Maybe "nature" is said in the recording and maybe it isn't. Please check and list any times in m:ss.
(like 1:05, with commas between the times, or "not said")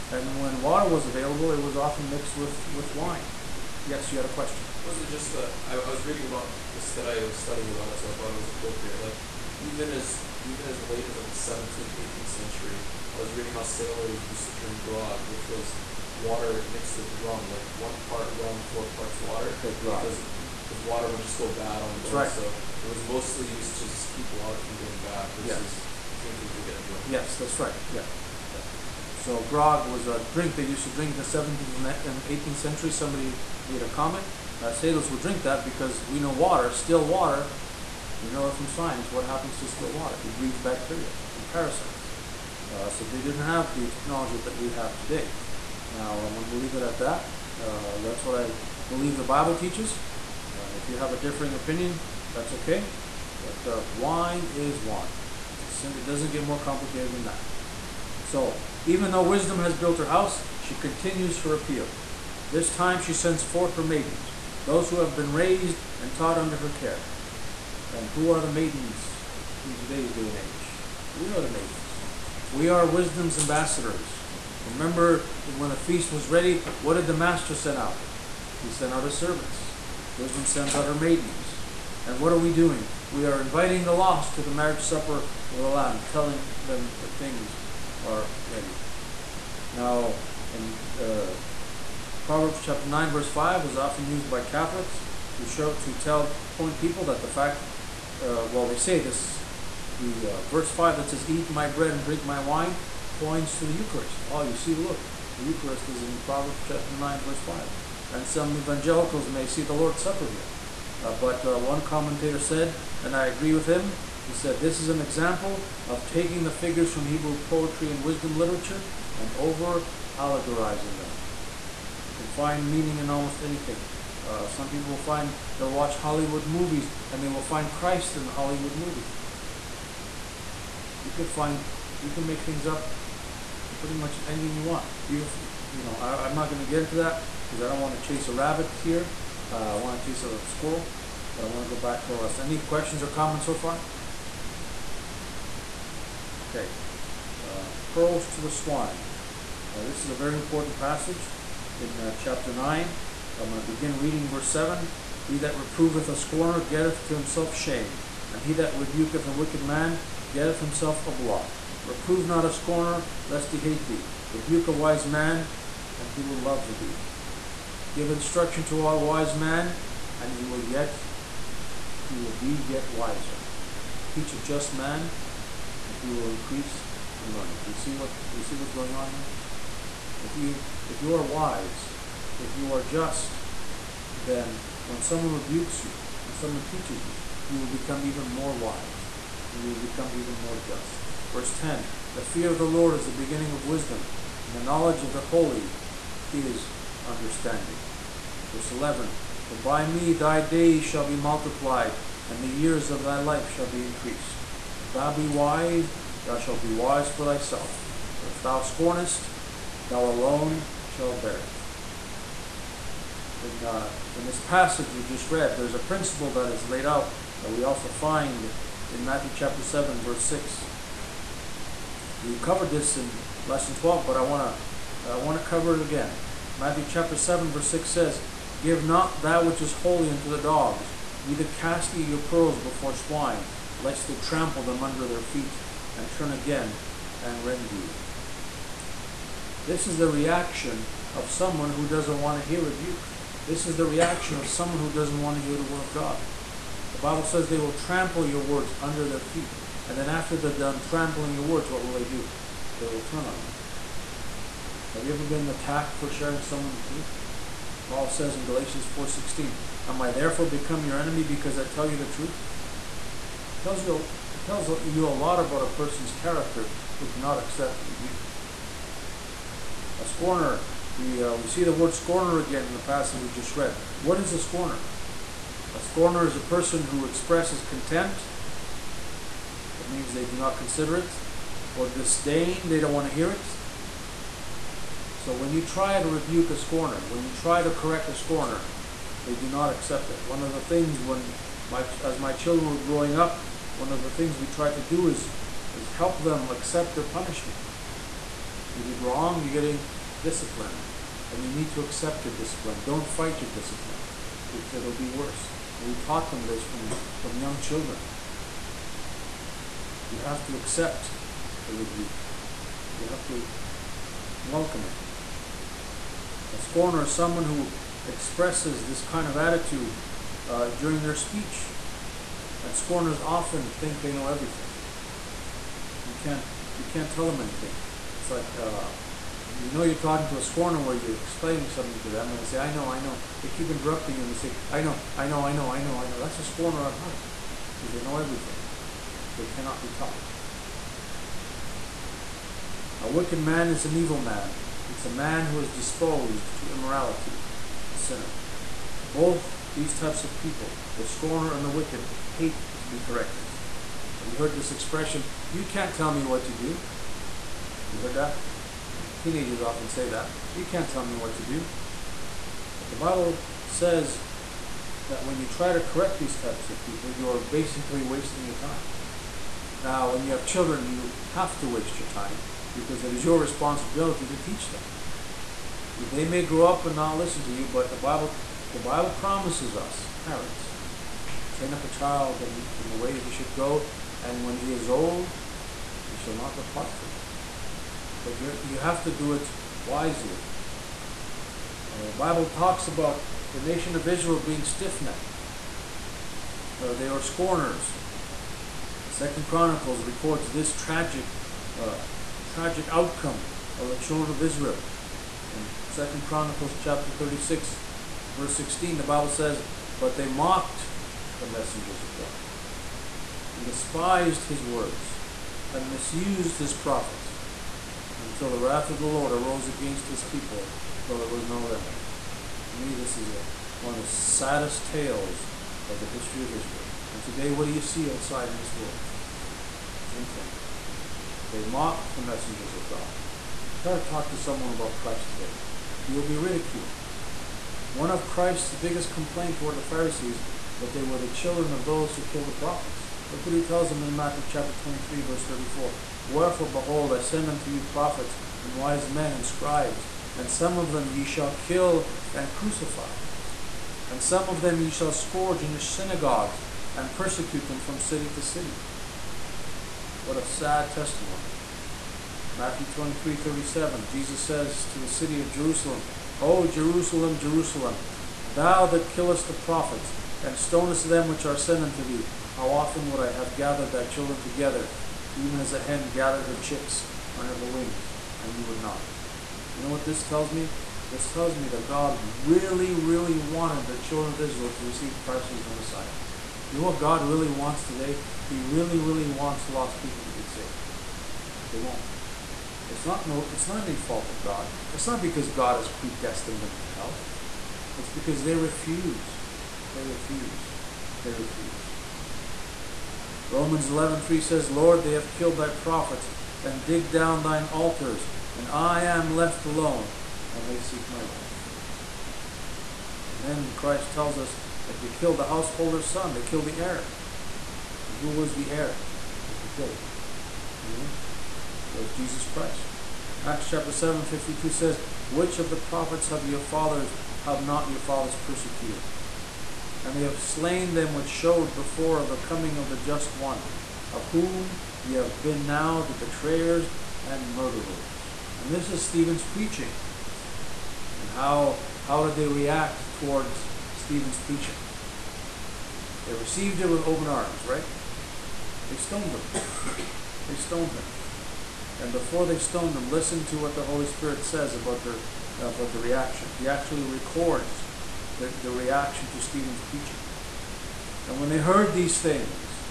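not said.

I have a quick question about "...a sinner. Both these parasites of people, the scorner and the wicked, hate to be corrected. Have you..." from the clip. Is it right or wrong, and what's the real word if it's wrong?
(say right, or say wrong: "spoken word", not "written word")
wrong: "types", not "parasites".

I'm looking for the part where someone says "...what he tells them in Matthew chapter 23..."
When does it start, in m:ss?
7:23.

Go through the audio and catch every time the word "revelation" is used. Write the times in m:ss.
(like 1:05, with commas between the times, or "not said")
not said.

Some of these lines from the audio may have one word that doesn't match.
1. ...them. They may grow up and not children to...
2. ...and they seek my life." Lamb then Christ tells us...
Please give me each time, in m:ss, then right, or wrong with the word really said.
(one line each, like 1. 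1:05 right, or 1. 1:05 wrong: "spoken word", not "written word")
1. 6:14 wrong: "listen", not "children"
2. 8:30 wrong: "And", not "Lamb".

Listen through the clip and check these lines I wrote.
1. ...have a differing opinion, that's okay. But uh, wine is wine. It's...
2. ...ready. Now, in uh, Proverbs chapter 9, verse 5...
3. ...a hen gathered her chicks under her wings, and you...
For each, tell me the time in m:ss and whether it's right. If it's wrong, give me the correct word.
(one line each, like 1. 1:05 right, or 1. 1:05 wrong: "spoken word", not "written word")
1. 0:50 right
2. 1:28 right
3. 7:55 right.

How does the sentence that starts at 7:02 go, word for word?
To me, this is a, one of the saddest tales of the history of Israel.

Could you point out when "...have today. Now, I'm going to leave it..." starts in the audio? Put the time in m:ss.
0:44.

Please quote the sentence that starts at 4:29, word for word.
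A scorner, we uh, we see the word scorner again in the passage we just read.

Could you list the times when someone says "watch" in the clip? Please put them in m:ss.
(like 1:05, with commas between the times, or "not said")
2:05.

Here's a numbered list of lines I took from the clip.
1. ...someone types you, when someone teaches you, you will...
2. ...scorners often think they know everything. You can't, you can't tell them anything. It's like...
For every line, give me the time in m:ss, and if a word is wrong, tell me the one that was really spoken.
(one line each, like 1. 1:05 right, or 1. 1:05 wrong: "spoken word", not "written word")
1. 3:05 wrong: "rebukes", not "types"
2. 5:22 right.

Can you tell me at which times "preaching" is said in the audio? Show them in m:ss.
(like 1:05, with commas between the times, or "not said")
8:59, 9:04, 9:19.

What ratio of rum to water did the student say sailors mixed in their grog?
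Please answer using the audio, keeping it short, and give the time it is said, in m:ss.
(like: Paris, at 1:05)
1 part rum, 4 parts water, at 0:17.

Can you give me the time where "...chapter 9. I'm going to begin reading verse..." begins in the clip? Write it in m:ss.
2:32.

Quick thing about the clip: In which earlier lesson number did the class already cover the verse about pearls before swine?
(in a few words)
Lesson 12.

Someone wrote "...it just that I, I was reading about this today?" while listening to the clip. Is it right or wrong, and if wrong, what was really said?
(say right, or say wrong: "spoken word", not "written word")
right.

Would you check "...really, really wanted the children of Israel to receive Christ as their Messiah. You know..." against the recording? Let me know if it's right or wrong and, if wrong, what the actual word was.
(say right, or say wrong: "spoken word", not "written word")
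right.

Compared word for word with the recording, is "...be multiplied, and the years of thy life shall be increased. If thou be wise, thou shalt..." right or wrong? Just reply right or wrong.
right.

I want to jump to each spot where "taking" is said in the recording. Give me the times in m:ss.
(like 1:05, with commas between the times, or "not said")
1:56.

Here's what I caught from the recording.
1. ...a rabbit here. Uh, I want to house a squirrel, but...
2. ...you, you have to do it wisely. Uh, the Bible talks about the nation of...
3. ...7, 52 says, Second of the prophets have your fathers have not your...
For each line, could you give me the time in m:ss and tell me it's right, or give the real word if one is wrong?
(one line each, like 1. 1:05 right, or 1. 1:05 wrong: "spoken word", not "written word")
1. 2:18 wrong: "chase", not "house"
2. 6:28 right
3. 8:43 wrong: "Which", not "Second".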